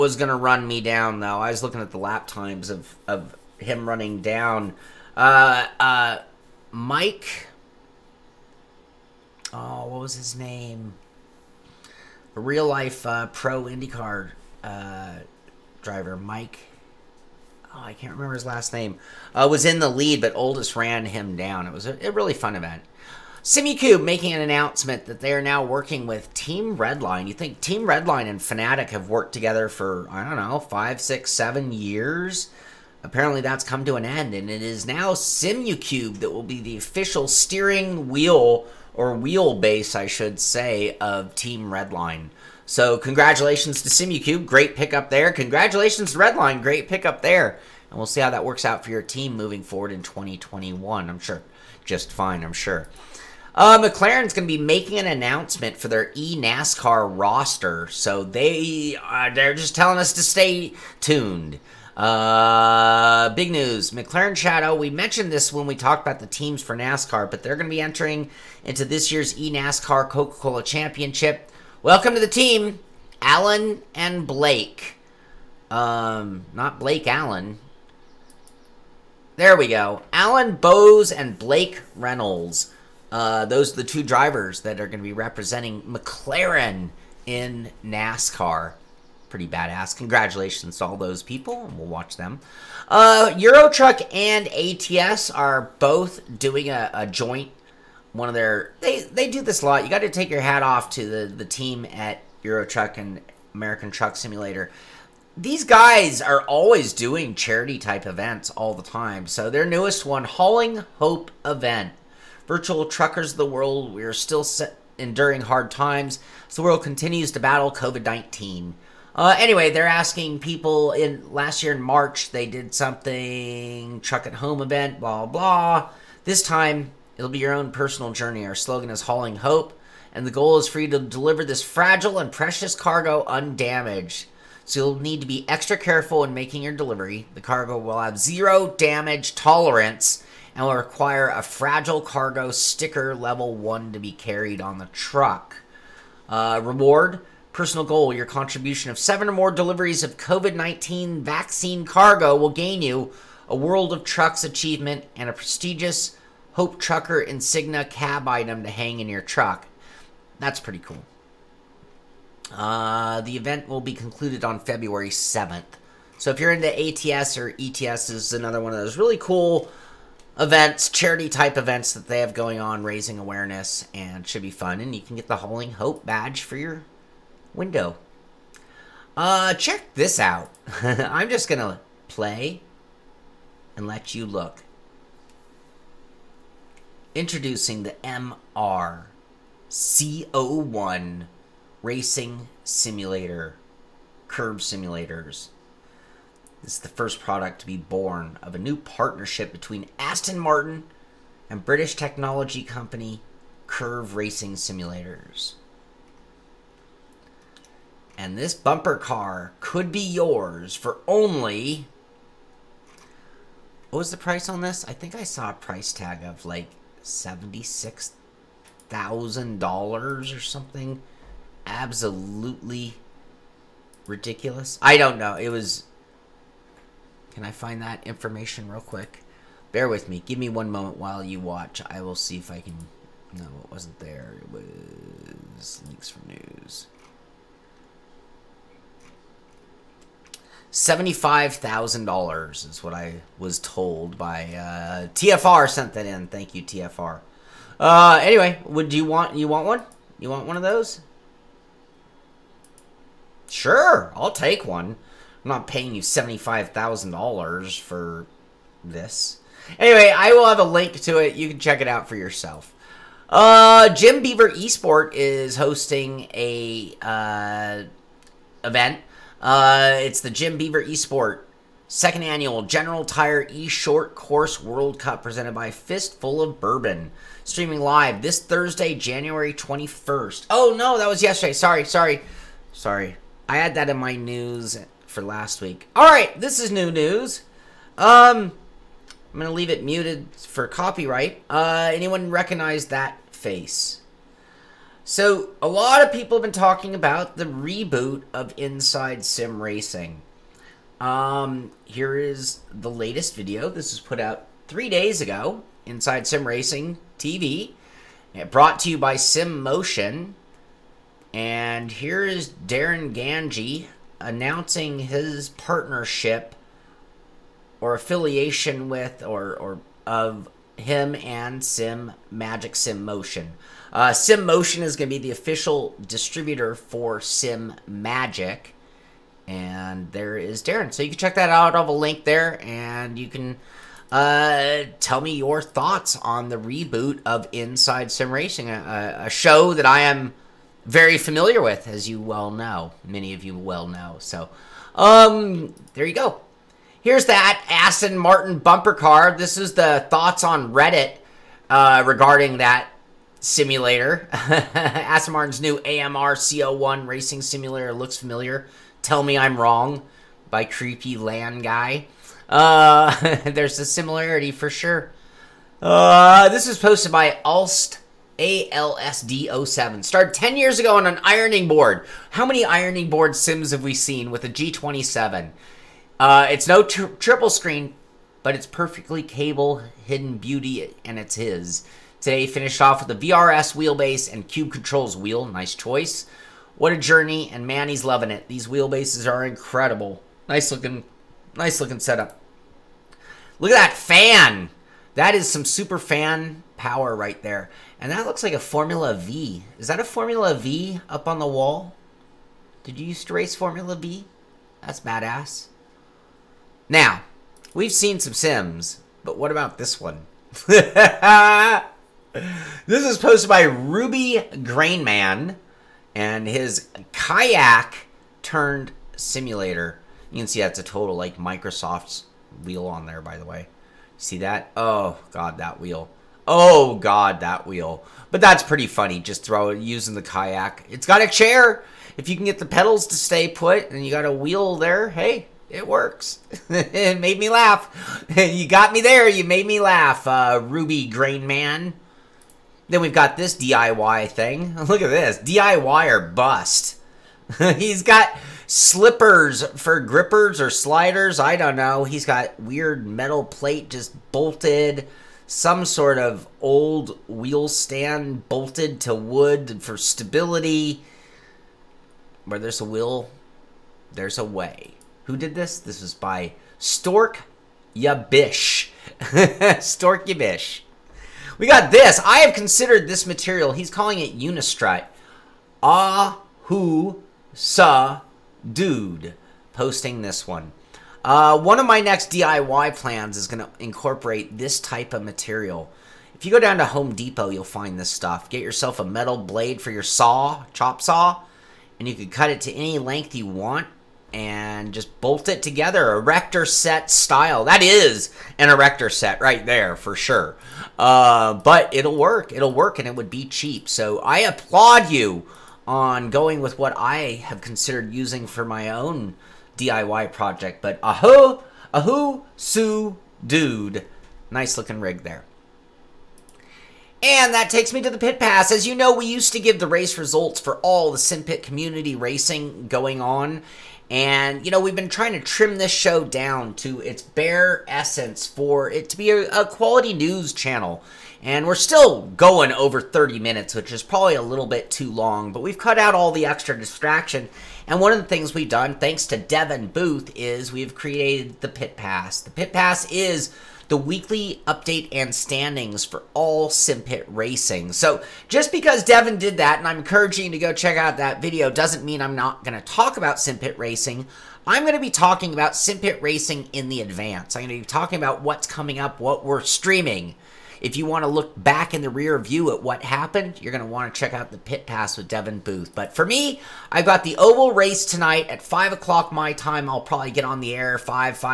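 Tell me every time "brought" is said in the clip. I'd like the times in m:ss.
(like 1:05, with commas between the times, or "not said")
5:08.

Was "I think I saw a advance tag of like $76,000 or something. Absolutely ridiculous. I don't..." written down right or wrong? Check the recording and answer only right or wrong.
wrong.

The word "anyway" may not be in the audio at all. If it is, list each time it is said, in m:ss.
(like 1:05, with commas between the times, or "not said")
1:59, 4:08, 4:19.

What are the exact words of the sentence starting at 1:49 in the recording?
So their newest one, Hauling Hope event, virtual truckers of the world.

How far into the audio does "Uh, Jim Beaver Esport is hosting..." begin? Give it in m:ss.
4:23.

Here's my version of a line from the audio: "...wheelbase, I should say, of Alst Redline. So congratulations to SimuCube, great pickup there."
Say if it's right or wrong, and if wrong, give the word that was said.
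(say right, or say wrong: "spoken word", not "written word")
wrong: "Team", not "Alst".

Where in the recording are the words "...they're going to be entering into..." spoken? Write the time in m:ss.
1:07.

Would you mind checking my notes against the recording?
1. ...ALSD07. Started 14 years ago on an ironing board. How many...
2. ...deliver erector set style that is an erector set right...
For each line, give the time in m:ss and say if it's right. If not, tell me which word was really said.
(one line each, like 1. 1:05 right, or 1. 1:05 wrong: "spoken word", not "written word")
1. 6:08 wrong: "10", not "14"
2. 8:15 wrong: "together", not "deliver".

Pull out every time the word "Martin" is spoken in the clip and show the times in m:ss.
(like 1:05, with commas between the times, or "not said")
3:20, 5:48, 5:55.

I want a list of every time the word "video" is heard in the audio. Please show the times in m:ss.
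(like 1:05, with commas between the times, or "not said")
5:03, 9:11.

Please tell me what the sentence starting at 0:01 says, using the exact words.
I was looking at the lap times of, of him running down.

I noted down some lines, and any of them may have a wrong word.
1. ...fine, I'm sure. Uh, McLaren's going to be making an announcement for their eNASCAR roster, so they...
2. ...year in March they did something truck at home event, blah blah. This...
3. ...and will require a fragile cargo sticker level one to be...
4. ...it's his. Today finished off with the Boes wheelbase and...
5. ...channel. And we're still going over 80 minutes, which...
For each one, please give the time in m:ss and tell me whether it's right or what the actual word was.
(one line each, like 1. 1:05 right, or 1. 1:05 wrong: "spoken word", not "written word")
1. 0:52 right
2. 2:01 right
3. 2:20 right
4. 6:21 wrong: "VRS", not "Boes"
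5. 8:50 wrong: "30", not "80".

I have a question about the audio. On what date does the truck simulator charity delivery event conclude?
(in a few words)
February 7th.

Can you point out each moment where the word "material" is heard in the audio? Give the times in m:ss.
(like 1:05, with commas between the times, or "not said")
7:53, 8:05.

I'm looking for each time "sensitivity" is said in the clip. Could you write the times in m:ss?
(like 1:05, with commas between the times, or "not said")
not said.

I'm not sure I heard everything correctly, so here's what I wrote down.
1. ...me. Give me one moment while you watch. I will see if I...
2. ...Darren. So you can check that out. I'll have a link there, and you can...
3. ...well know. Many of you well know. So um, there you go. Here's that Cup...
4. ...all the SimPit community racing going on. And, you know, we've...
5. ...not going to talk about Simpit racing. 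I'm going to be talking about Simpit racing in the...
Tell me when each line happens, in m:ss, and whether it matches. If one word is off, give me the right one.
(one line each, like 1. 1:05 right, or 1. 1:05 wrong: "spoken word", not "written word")
1. 3:50 right
2. 5:30 right
3. 5:42 wrong: "Aston", not "Cup"
4. 8:40 right
5. 9:12 right.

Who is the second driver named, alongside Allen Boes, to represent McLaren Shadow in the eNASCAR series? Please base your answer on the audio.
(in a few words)
Blake Reynolds.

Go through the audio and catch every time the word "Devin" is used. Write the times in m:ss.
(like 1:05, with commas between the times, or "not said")
8:59, 9:09, 9:25.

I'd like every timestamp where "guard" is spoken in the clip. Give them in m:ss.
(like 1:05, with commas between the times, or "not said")
not said.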